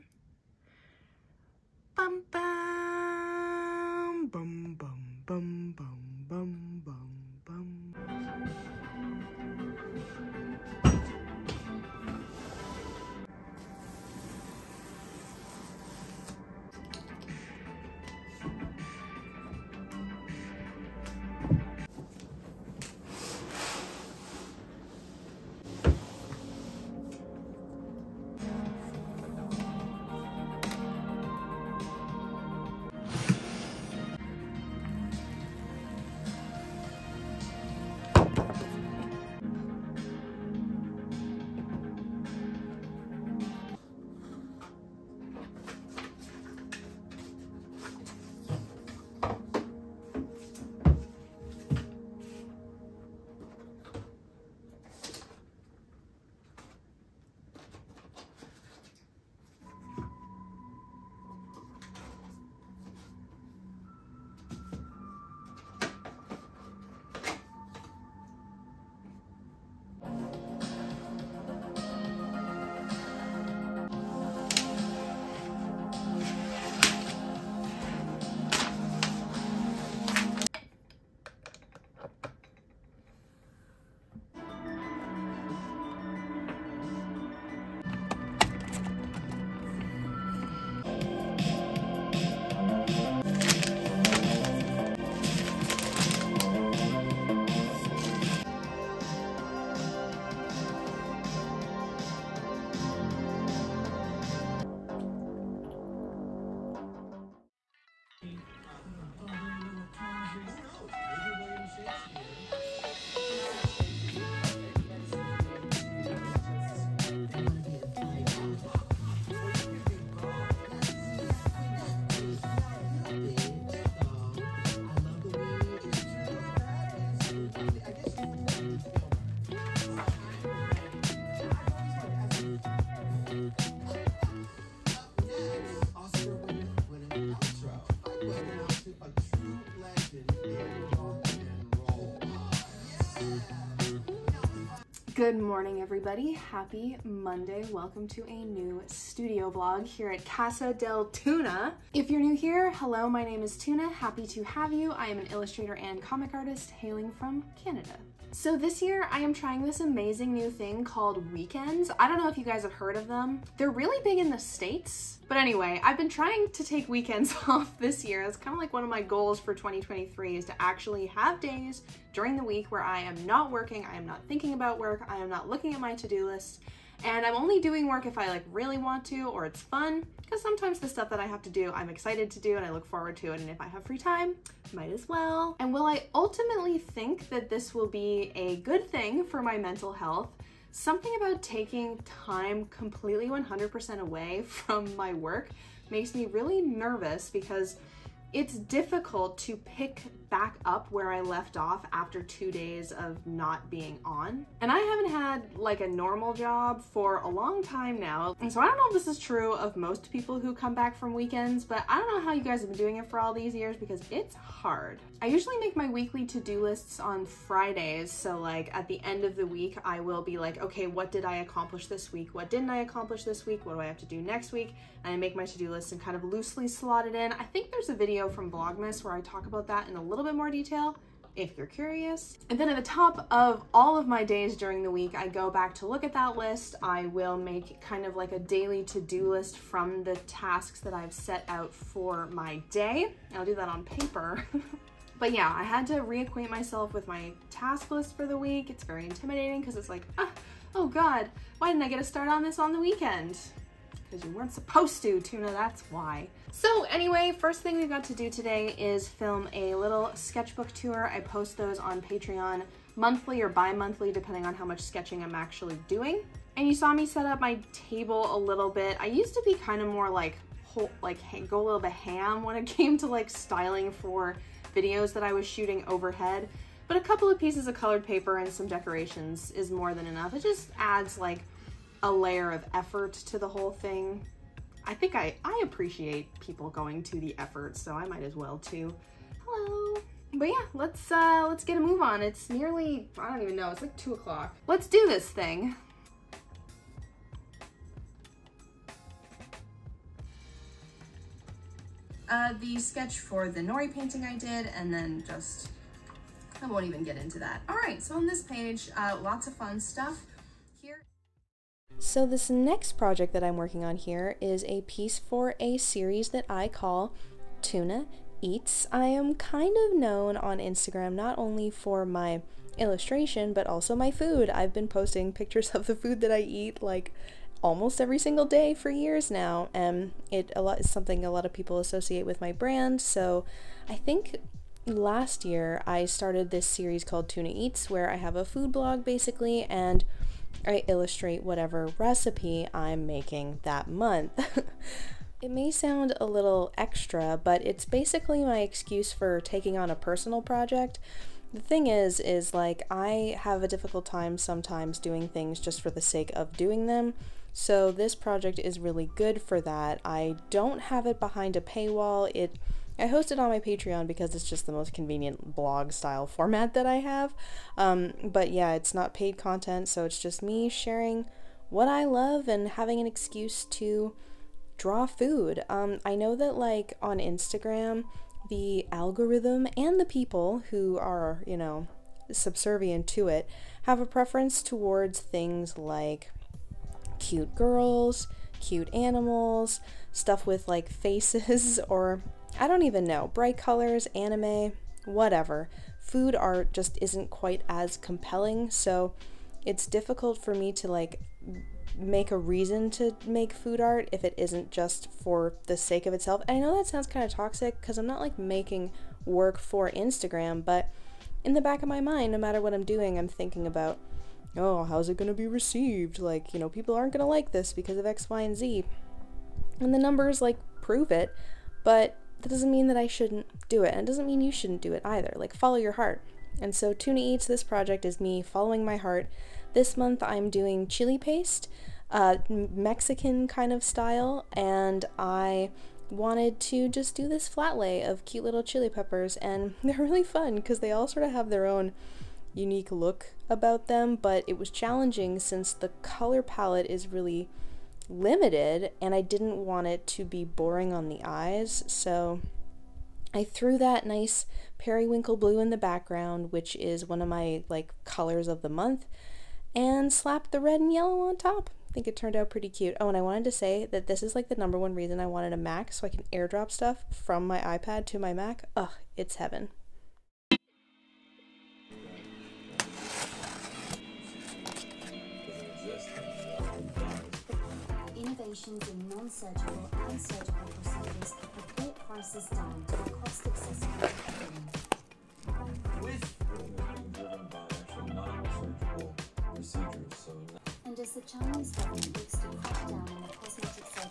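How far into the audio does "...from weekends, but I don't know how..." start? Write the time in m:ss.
3:30.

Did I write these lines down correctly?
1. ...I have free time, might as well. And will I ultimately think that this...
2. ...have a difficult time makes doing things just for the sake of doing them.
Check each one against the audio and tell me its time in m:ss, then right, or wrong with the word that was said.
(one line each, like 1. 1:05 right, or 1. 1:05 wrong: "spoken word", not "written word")
1. 3:03 right
2. 5:53 wrong: "sometimes", not "makes".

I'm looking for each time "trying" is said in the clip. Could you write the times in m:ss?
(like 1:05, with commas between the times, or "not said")
2:39, 2:46.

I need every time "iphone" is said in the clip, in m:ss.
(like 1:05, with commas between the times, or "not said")
not said.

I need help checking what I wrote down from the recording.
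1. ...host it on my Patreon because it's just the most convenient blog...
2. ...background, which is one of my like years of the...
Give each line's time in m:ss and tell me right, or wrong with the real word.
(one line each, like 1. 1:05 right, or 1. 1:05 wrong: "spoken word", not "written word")
1. 6:03 right
2. 7:35 wrong: "colors", not "years".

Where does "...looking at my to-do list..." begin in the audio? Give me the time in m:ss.
2:55.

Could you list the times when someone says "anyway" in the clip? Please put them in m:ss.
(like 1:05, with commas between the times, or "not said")
2:45, 4:16.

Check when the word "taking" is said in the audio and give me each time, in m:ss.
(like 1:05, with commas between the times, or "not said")
3:11, 5:49.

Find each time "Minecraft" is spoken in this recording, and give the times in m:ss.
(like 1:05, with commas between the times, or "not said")
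not said.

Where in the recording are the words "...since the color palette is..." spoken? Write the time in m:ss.
7:25.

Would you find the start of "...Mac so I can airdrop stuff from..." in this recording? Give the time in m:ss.
7:45.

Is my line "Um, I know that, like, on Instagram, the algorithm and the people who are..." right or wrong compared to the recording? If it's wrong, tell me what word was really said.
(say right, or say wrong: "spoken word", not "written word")
right.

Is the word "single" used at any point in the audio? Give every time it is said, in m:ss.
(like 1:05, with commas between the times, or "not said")
5:28.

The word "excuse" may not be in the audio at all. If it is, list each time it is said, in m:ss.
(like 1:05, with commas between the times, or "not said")
5:48, 6:13.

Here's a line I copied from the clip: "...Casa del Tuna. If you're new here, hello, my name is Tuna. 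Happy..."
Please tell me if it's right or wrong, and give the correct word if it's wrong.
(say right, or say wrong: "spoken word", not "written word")
right.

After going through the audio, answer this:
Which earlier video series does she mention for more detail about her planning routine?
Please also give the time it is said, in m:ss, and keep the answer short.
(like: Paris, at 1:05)
Vlogmas, at 3:48.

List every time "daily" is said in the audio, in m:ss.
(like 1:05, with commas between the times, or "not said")
3:58.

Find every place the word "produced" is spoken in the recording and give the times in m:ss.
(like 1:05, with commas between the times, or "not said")
not said.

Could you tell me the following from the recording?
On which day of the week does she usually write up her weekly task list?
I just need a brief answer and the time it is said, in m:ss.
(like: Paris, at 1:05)
Fridays, at 3:37.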